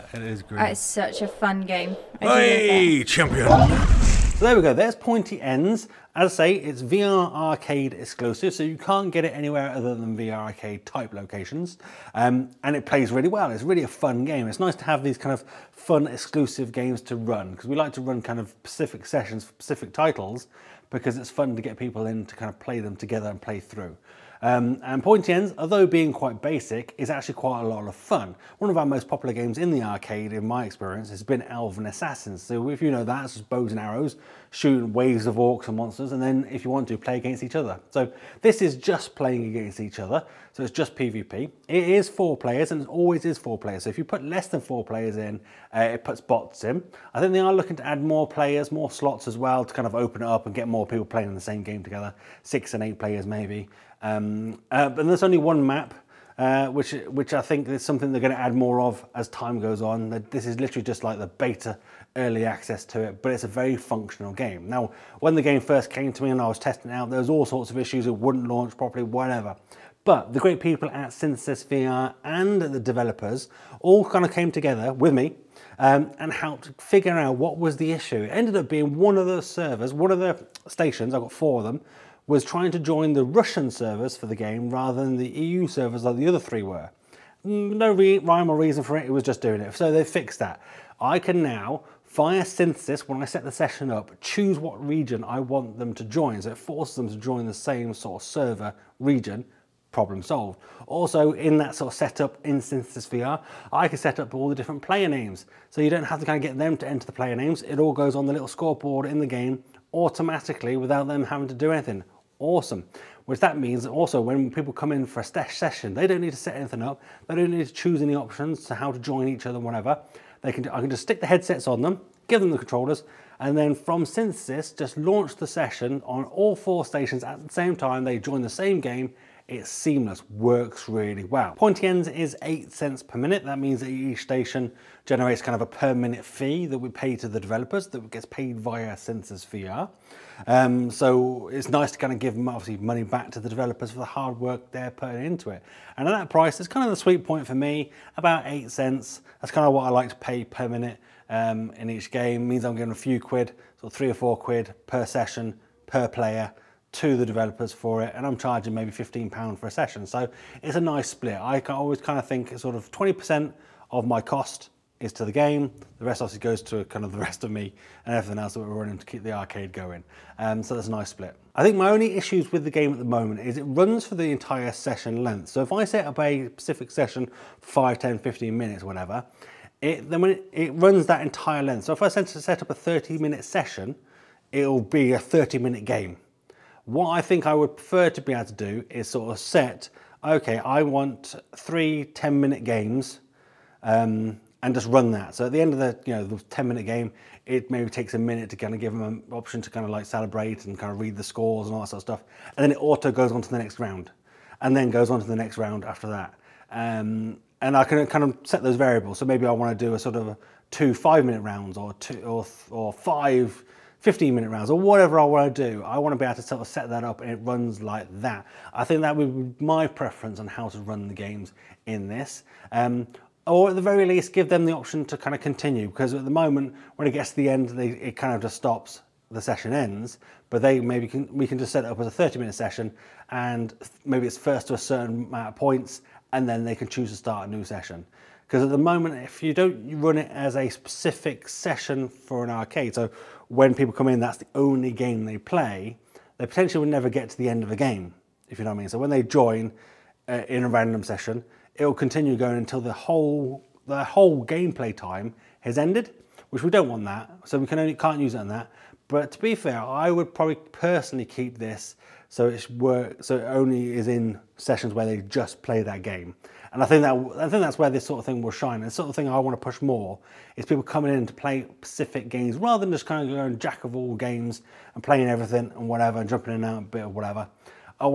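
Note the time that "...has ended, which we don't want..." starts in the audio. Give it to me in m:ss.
4:15.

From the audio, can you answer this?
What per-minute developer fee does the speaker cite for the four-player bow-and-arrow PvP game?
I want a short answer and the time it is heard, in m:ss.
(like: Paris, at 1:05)
8 cents, at 2:12.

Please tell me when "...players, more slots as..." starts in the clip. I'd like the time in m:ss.
0:48.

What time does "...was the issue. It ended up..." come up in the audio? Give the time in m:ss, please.
1:17.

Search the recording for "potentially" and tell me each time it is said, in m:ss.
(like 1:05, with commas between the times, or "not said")
4:06.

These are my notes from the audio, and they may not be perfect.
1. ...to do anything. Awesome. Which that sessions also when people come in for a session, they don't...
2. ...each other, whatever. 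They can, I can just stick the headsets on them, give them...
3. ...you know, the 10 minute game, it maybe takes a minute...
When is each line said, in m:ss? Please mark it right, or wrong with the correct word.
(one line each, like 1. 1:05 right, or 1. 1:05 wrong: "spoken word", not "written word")
1. 1:51 wrong: "means", not "sessions"
2. 1:59 right
3. 3:16 right.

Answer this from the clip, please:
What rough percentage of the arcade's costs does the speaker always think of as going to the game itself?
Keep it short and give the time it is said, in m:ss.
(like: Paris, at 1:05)
20%, at 2:42.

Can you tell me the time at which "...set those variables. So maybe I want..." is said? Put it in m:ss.
3:28.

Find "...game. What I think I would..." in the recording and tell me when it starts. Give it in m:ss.
3:05.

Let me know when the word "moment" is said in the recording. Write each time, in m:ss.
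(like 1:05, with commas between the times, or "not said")
2:53, 3:46, 3:58.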